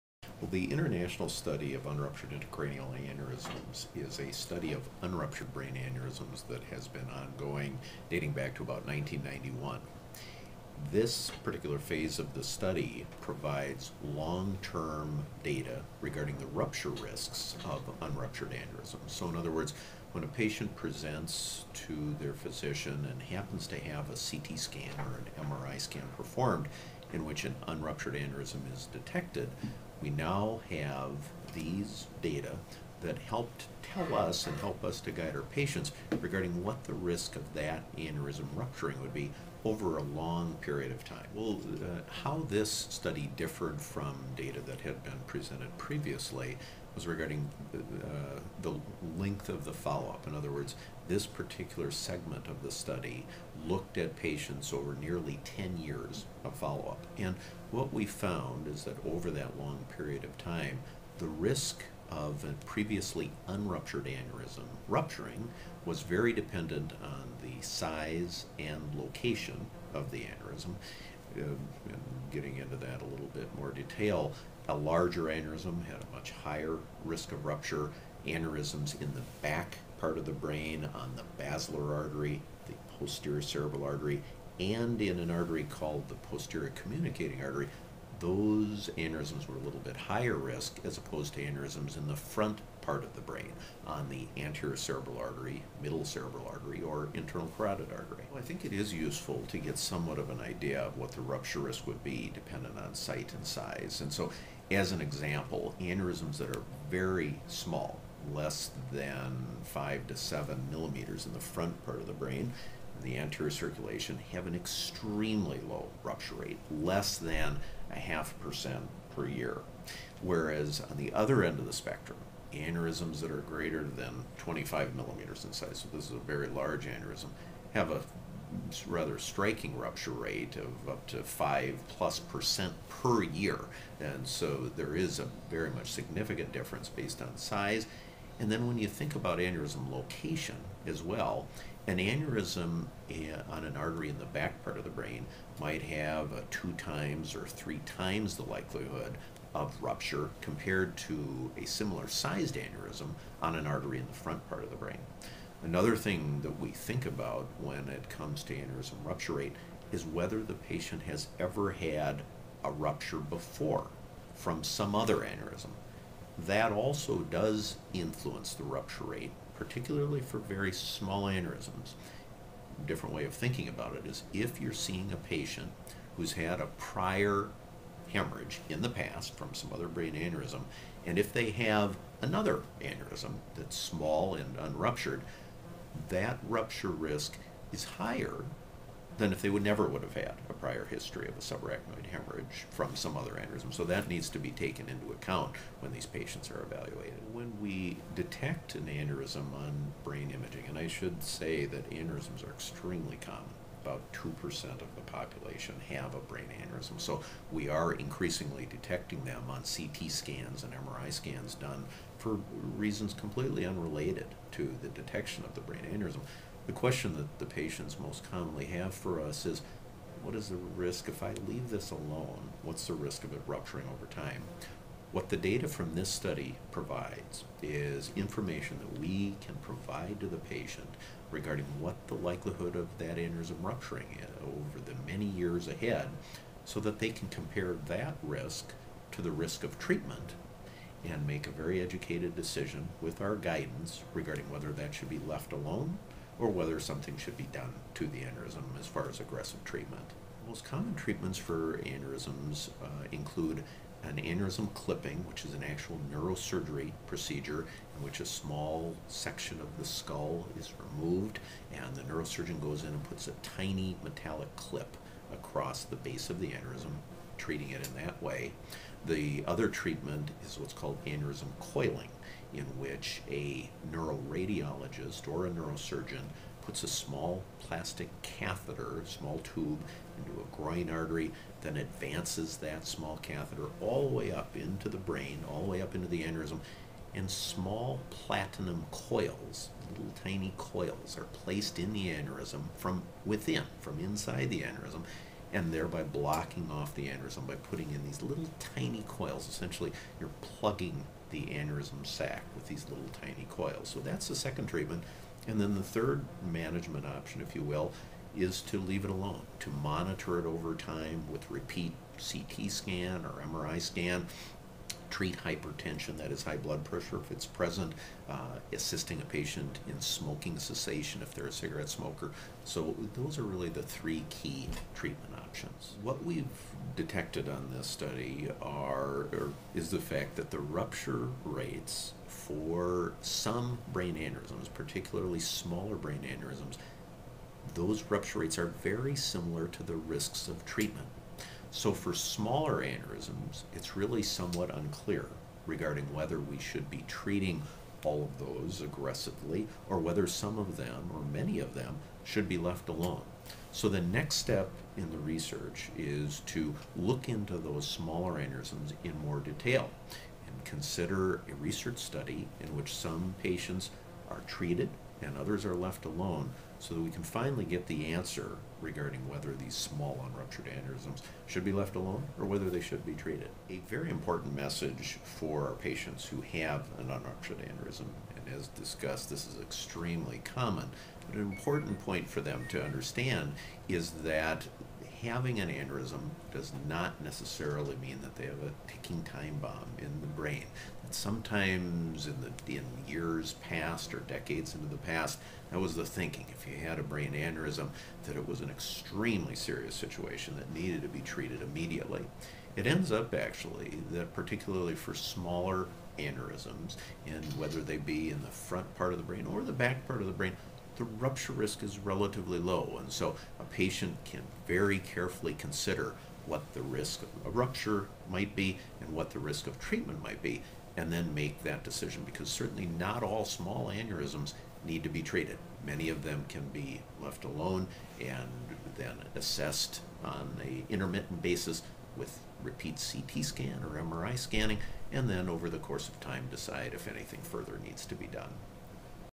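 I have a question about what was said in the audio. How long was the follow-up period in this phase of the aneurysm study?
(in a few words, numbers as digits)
nearly 10 years.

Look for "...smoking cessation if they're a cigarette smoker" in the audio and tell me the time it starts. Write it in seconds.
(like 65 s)
319 s.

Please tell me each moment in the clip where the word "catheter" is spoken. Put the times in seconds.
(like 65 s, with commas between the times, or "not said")
278 s, 283 s.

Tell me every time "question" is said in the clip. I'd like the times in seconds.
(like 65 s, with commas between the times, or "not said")
216 s.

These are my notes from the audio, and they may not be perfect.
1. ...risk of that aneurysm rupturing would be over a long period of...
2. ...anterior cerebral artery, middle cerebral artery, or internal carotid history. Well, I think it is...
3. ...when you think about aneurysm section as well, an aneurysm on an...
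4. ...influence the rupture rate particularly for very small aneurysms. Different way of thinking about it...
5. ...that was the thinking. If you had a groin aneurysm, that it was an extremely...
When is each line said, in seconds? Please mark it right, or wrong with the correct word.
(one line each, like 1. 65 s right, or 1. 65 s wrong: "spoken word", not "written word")
1. 36 s right
2. 94 s wrong: "artery", not "history"
3. 138 s wrong: "location", not "section"
4. 167 s right
5. 395 s wrong: "brain", not "groin".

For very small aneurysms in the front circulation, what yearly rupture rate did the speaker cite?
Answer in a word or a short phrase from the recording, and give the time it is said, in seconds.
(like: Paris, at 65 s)
less than 0.5%, at 116 s.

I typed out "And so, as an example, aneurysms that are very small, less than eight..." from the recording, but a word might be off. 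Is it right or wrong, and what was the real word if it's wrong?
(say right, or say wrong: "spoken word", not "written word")
wrong: "five", not "eight".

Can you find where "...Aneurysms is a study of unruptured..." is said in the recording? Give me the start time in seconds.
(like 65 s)
2 s.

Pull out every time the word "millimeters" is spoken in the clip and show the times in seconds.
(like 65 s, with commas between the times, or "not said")
110 s, 124 s.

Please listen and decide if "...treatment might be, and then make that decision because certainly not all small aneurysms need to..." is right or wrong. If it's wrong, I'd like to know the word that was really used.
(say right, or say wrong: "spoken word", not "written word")
right.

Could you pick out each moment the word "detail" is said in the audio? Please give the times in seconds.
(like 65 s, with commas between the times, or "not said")
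73 s, 359 s.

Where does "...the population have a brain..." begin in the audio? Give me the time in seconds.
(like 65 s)
204 s.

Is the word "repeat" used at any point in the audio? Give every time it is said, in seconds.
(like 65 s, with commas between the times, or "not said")
311 s, 432 s.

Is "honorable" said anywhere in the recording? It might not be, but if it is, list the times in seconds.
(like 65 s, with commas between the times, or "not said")
not said.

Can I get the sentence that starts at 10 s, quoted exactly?
This particular phase of the study provides long term data regarding the rupture risks of unruptured aneurysms.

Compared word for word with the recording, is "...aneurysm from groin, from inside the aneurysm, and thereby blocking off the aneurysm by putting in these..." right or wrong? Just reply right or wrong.
wrong.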